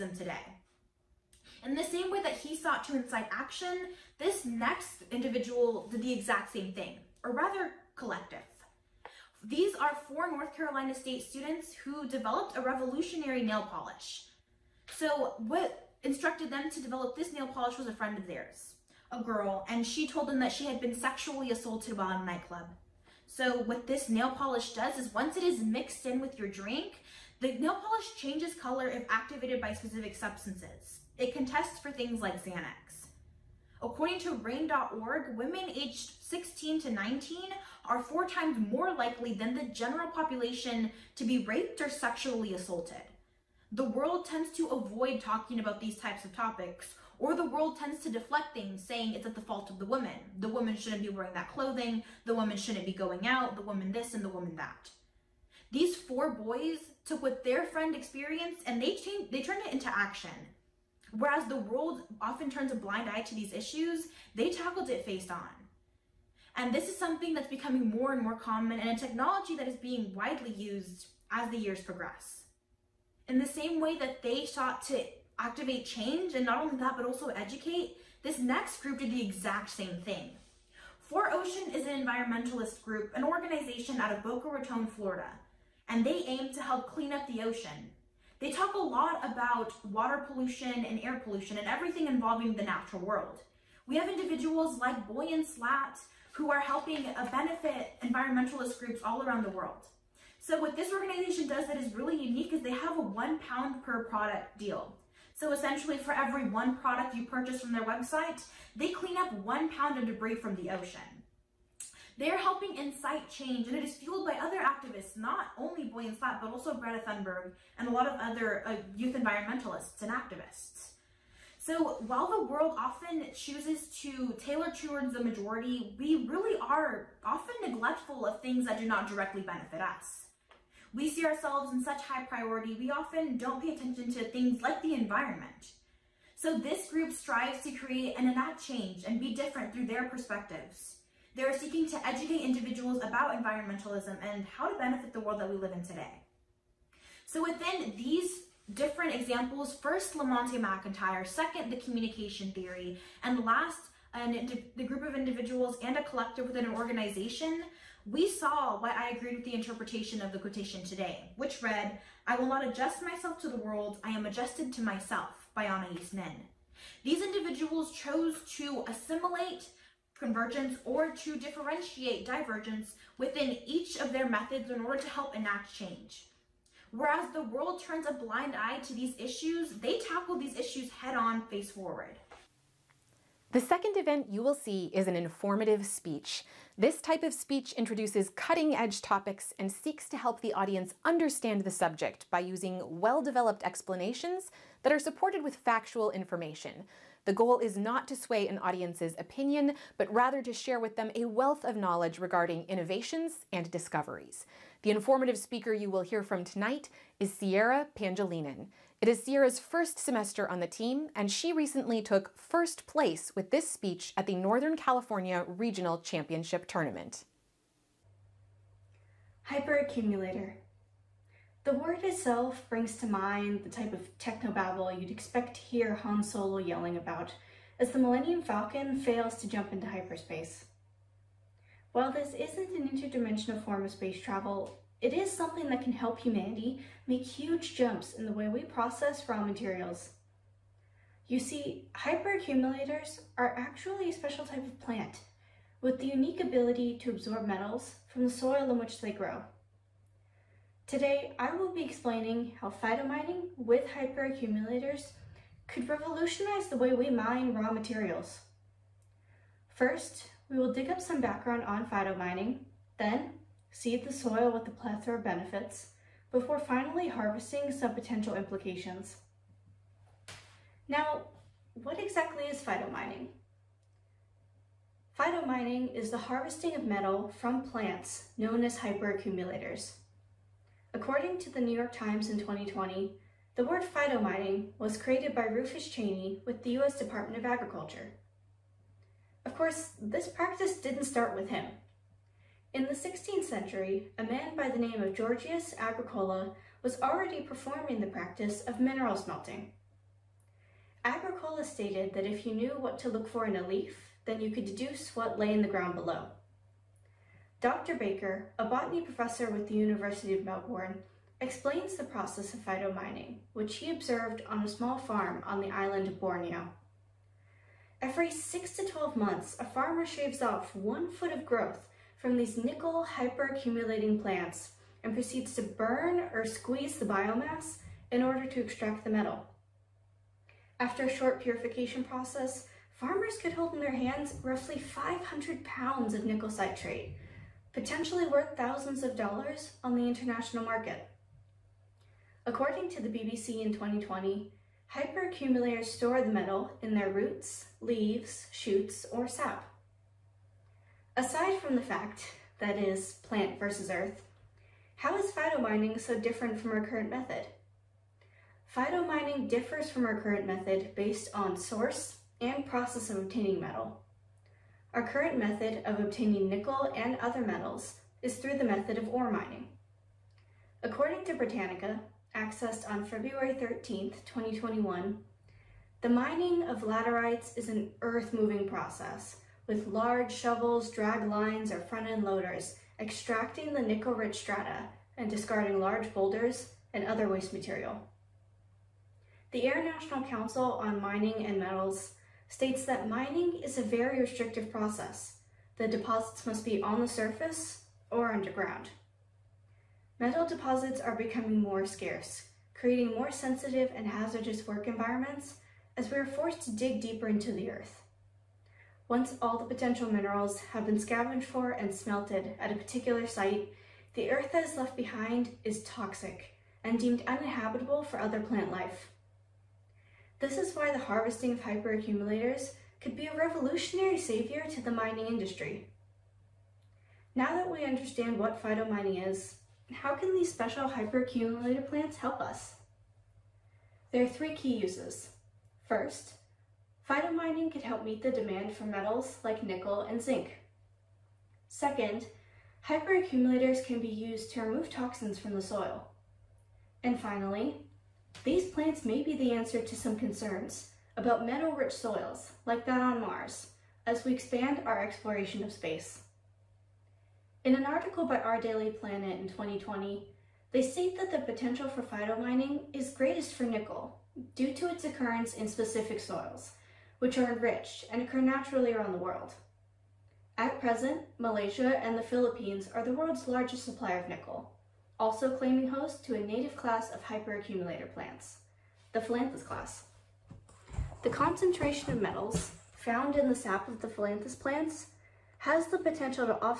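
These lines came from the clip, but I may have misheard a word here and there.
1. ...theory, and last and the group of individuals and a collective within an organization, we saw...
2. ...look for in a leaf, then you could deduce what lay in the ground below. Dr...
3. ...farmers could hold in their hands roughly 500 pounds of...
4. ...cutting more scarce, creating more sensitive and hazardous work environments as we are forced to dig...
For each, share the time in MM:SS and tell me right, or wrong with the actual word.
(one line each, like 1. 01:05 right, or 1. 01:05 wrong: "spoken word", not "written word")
1. 02:32 right
2. 05:03 right
3. 05:32 right
4. 06:41 wrong: "becoming", not "cutting".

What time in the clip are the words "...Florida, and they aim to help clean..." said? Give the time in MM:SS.
01:24.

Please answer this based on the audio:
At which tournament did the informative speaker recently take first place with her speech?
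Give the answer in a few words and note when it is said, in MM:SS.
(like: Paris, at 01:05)
Northern California Regional Championship, at 03:34.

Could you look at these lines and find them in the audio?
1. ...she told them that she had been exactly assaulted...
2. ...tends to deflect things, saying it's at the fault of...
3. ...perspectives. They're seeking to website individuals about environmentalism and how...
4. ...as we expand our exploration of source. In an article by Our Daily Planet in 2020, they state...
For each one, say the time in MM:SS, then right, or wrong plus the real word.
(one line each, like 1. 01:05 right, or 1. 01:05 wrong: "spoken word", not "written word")
1. 00:19 wrong: "sexually", not "exactly"
2. 00:47 right
3. 02:20 wrong: "educate", not "website"
4. 07:34 wrong: "space", not "source".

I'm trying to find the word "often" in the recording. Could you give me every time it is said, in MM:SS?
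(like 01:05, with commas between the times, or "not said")
01:02, 02:02, 02:07, 02:12.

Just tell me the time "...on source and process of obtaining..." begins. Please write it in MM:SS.
06:01.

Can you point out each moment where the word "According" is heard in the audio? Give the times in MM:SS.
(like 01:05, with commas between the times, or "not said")
00:33, 04:40, 05:42, 06:10.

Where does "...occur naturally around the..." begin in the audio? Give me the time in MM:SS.
07:48.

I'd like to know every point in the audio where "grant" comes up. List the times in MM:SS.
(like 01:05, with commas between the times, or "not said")
not said.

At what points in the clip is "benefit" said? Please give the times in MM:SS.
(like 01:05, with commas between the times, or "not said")
01:37, 02:09, 02:24, 04:25.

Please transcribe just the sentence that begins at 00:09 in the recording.
These are four North Carolina State students who developed a revolutionary nail polish.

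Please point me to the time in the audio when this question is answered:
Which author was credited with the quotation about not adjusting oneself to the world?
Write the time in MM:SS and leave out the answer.
02:45.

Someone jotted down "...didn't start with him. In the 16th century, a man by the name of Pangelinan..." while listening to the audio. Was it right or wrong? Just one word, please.
wrong.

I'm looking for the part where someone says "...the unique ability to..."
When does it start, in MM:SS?
04:05.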